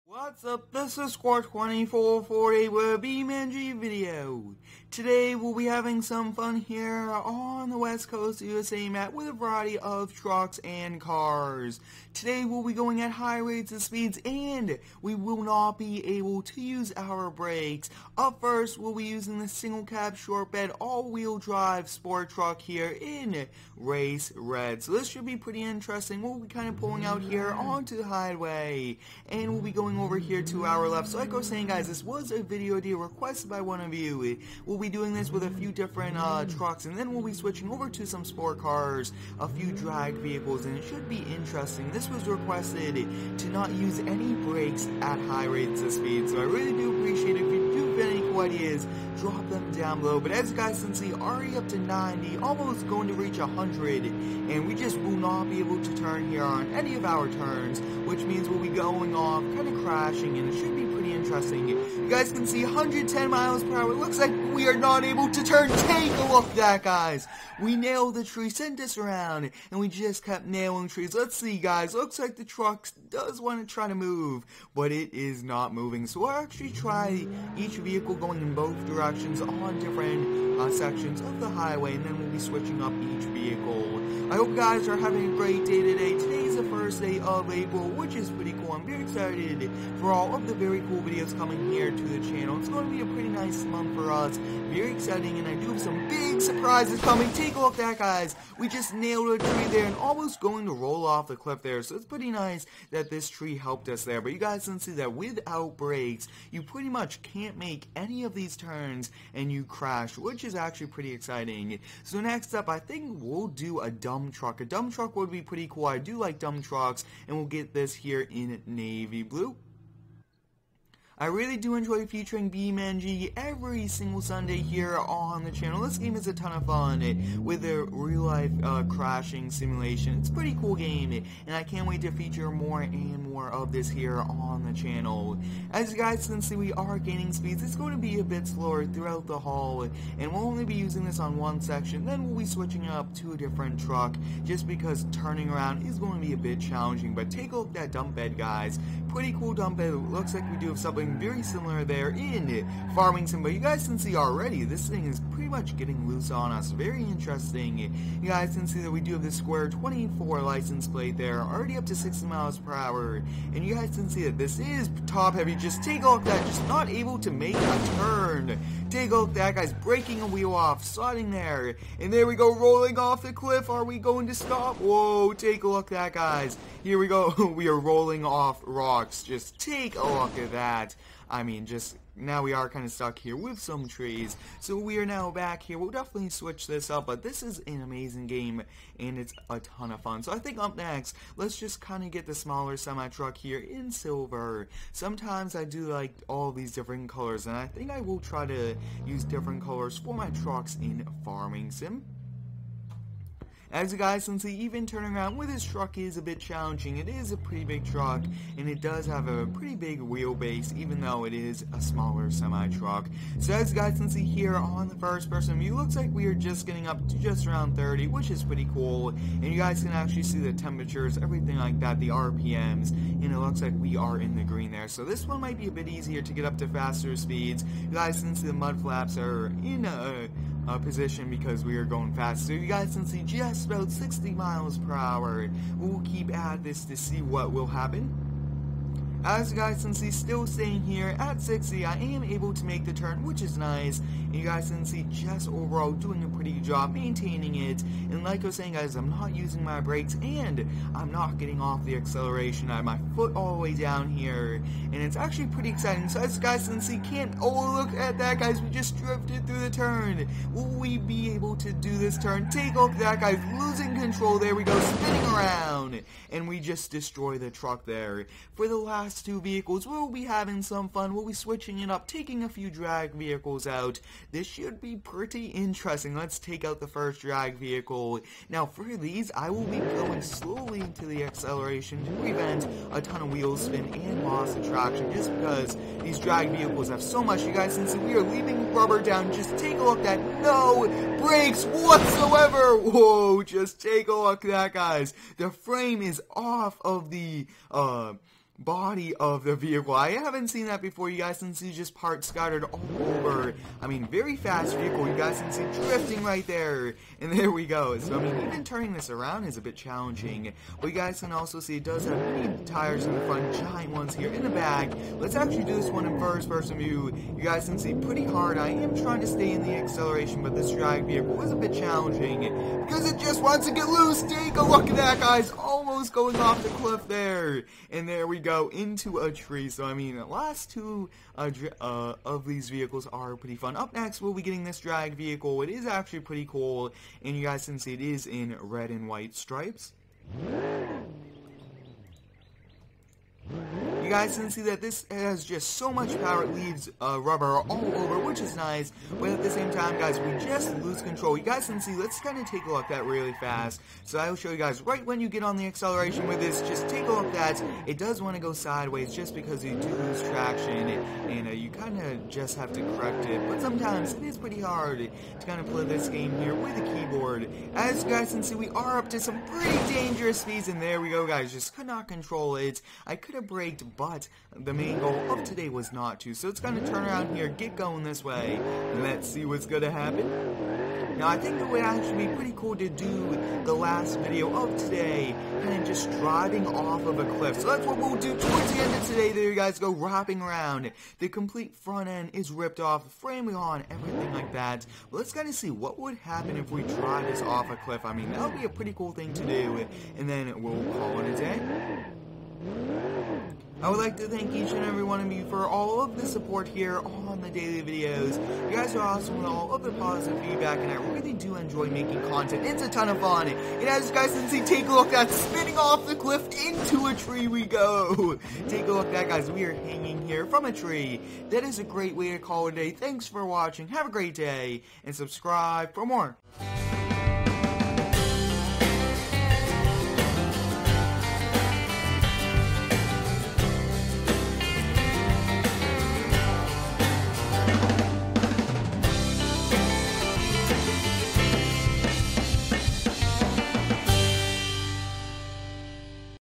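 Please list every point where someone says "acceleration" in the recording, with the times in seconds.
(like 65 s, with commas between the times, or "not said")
251 s, 281 s, 319 s, 355 s.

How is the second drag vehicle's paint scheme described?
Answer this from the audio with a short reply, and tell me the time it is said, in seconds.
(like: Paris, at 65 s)
Red and white stripes, at 338 s.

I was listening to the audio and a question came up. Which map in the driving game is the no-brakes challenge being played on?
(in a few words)
West Coast USA.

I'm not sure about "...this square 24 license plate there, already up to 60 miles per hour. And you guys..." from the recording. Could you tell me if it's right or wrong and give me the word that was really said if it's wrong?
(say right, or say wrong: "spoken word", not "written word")
right.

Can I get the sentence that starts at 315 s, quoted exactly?
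Let's actually do this one in first person view.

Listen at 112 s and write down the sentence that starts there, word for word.
So next up, I think we'll do a dump truck.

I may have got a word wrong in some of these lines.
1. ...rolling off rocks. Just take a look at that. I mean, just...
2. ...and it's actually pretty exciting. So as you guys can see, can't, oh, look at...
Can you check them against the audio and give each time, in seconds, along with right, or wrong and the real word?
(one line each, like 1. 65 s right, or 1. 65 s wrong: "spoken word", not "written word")
1. 177 s right
2. 254 s right.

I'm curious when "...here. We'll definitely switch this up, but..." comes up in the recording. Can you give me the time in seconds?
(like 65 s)
185 s.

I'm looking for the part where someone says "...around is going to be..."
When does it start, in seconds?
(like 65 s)
145 s.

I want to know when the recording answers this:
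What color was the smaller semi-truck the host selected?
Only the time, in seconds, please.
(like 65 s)
193 s.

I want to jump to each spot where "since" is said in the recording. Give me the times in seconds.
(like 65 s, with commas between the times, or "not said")
204 s, 213 s, 228 s, 287 s.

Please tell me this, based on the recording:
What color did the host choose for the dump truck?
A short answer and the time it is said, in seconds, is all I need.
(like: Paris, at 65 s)
Navy blue, at 118 s.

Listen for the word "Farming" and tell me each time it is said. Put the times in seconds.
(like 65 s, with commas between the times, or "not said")
152 s, 201 s.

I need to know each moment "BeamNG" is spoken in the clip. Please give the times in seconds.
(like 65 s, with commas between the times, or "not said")
3 s, 122 s.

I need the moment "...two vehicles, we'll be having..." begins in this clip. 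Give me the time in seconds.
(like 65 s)
269 s.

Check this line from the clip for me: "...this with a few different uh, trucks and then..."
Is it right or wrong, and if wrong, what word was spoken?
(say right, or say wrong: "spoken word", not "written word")
right.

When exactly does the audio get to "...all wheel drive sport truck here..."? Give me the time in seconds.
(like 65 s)
20 s.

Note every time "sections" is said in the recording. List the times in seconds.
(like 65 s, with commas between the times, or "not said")
80 s, 141 s.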